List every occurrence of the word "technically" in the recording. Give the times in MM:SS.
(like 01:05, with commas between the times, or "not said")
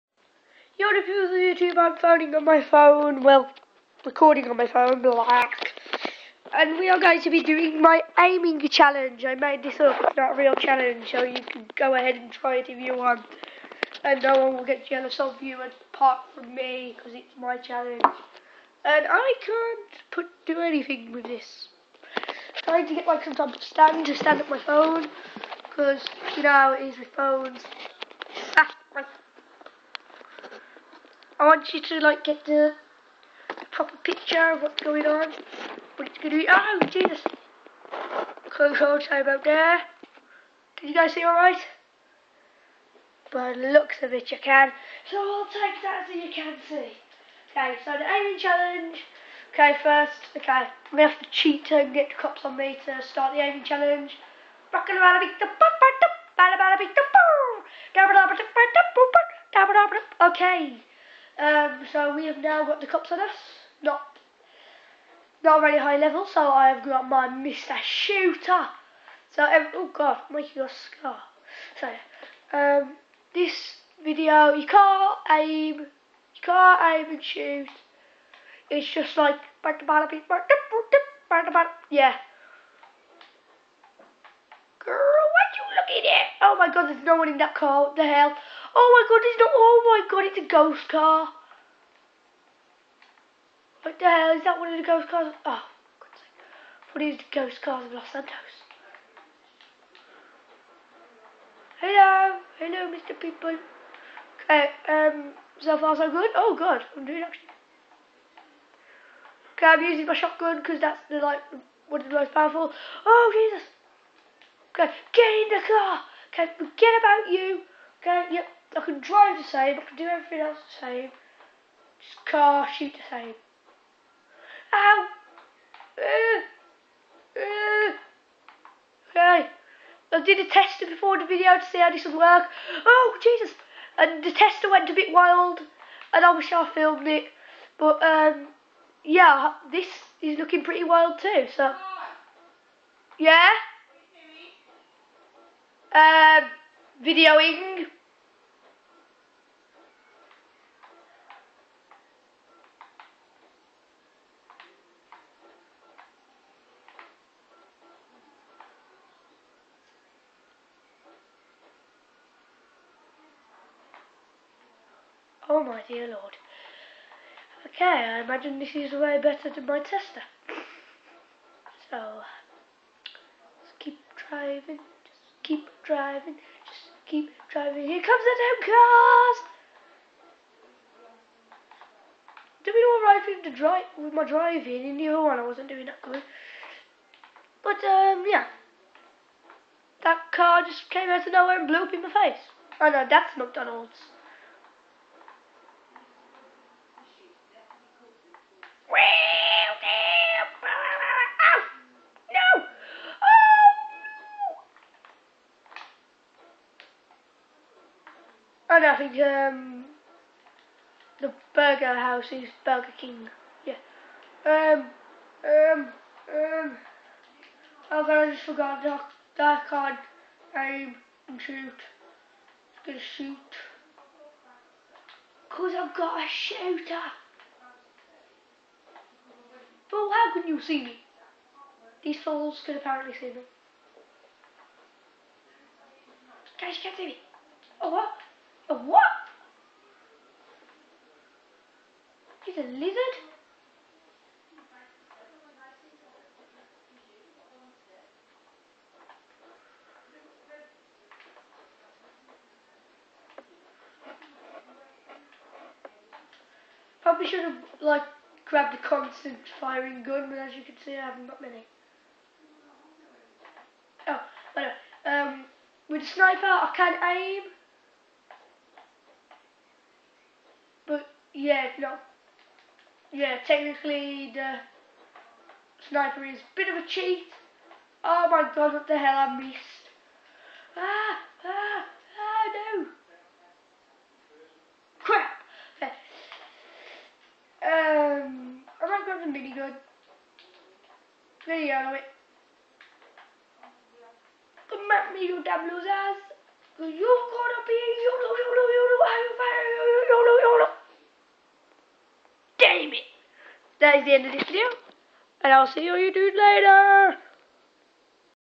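04:33.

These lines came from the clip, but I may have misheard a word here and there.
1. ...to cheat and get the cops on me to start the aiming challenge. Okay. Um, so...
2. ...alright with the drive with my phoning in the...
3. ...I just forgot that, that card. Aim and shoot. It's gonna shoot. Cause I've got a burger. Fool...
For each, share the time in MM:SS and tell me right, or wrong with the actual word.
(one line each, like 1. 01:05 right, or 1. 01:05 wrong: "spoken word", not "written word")
1. 00:51 right
2. 03:02 wrong: "driving", not "phoning"
3. 03:38 wrong: "shooter", not "burger".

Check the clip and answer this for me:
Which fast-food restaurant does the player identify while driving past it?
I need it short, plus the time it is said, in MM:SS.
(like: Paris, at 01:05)
McDonald's, at 03:13.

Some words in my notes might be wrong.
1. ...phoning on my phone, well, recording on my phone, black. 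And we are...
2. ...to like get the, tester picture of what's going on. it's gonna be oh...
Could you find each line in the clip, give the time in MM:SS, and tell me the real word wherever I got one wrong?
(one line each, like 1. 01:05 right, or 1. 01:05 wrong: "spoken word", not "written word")
1. 00:01 right
2. 00:31 wrong: "proper", not "tester".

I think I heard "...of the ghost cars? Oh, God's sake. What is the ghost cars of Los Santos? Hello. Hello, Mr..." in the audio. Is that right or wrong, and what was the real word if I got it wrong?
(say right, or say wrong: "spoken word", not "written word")
right.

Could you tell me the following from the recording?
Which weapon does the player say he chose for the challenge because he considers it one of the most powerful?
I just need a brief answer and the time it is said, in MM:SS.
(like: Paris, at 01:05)
Shotgun, at 01:50.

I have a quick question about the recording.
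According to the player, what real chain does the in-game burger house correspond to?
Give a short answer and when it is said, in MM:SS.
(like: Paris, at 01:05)
Burger King, at 03:32.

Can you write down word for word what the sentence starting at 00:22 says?
I'm trying to get like some type of stand to stand up my phone, because you know it is with phones.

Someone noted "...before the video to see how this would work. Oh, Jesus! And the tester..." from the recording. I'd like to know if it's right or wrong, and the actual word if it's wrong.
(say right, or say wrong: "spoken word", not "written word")
right.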